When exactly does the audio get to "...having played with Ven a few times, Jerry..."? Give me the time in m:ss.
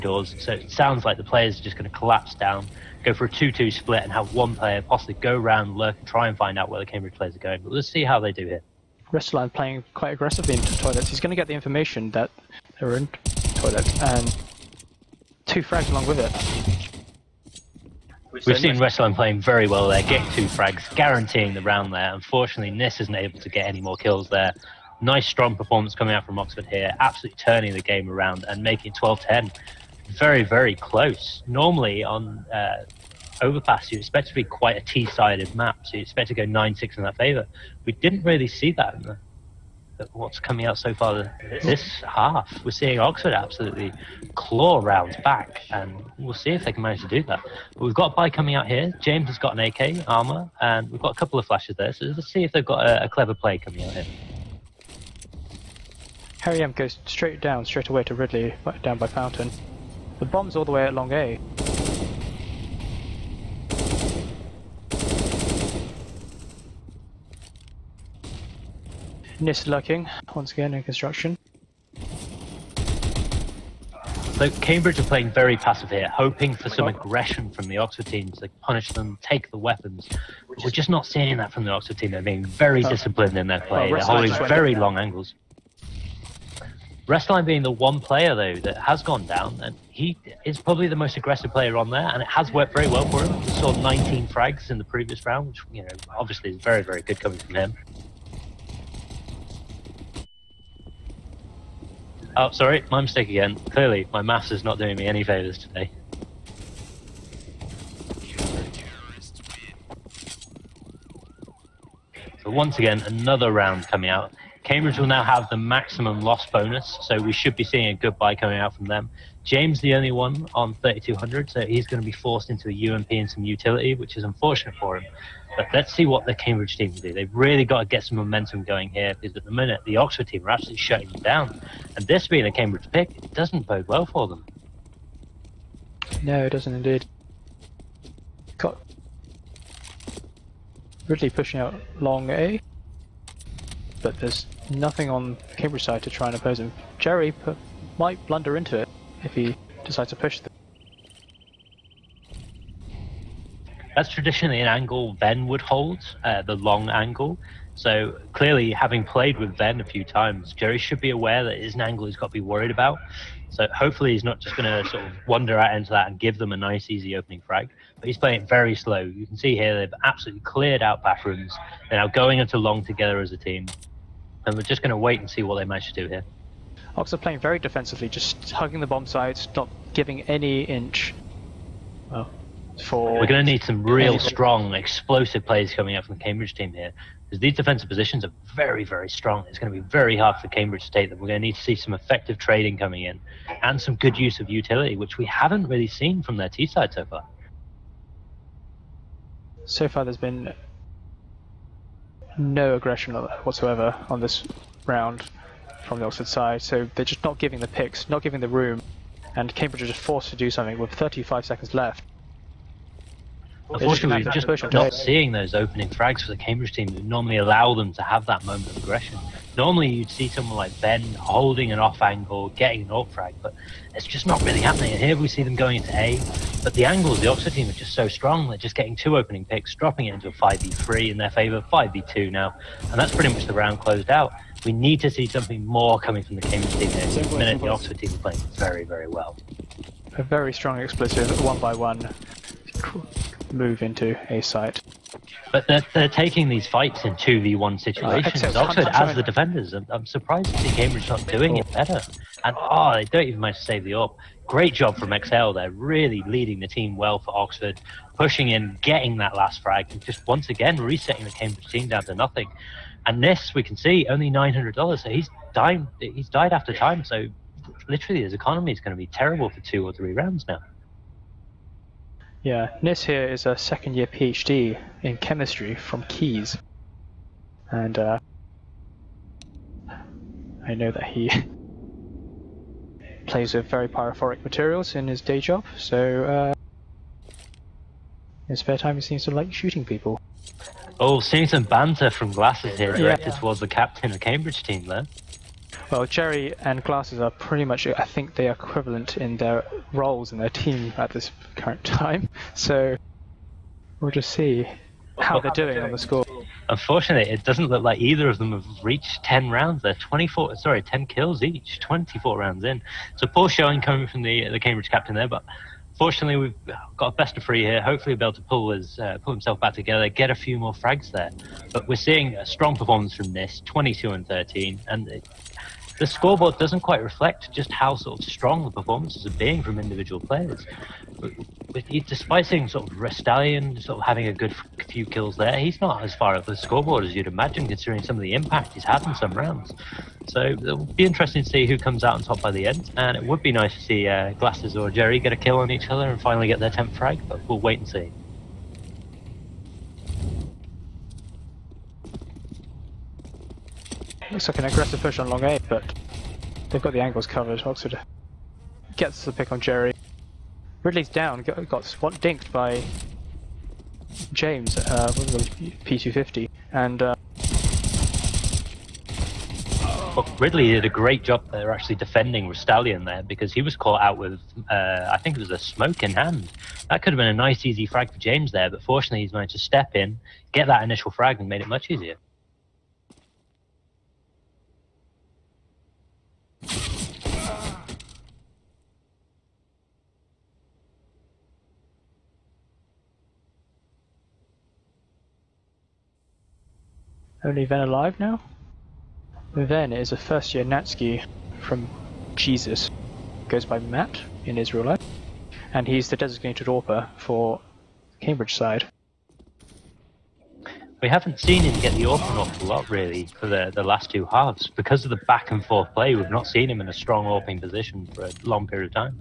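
2:38.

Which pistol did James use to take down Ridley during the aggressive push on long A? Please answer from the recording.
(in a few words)
P250.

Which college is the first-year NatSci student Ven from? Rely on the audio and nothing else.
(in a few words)
Jesus.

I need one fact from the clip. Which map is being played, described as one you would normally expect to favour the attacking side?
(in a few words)
Overpass.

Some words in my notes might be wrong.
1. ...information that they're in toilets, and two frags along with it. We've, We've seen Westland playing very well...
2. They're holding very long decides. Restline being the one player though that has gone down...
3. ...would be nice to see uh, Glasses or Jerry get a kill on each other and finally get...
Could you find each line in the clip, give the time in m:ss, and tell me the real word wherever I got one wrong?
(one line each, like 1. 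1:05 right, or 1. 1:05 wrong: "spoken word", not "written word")
1. 0:11 right
2. 1:23 wrong: "angles", not "decides"
3. 5:43 right.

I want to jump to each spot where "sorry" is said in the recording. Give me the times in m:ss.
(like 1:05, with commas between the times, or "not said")
1:42, 5:10.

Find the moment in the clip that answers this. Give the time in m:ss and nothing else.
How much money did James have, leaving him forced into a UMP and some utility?
2:00.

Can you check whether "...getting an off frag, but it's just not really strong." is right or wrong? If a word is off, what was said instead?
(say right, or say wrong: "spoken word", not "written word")
wrong: "happening", not "strong".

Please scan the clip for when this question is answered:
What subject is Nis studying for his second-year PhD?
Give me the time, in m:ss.
4:35.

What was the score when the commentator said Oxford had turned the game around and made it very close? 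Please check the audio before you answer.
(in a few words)
12-10.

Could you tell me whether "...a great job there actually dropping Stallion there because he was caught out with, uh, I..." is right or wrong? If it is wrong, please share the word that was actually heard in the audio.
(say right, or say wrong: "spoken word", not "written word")
wrong: "defending", not "dropping".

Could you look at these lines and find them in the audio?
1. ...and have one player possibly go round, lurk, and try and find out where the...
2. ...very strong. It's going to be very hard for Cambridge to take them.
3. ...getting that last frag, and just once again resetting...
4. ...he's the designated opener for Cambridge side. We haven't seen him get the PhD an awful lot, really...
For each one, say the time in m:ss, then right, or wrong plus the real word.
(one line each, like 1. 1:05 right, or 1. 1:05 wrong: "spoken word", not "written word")
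1. 0:04 right
2. 3:08 right
3. 4:18 right
4. 6:45 wrong: "AWP", not "PhD".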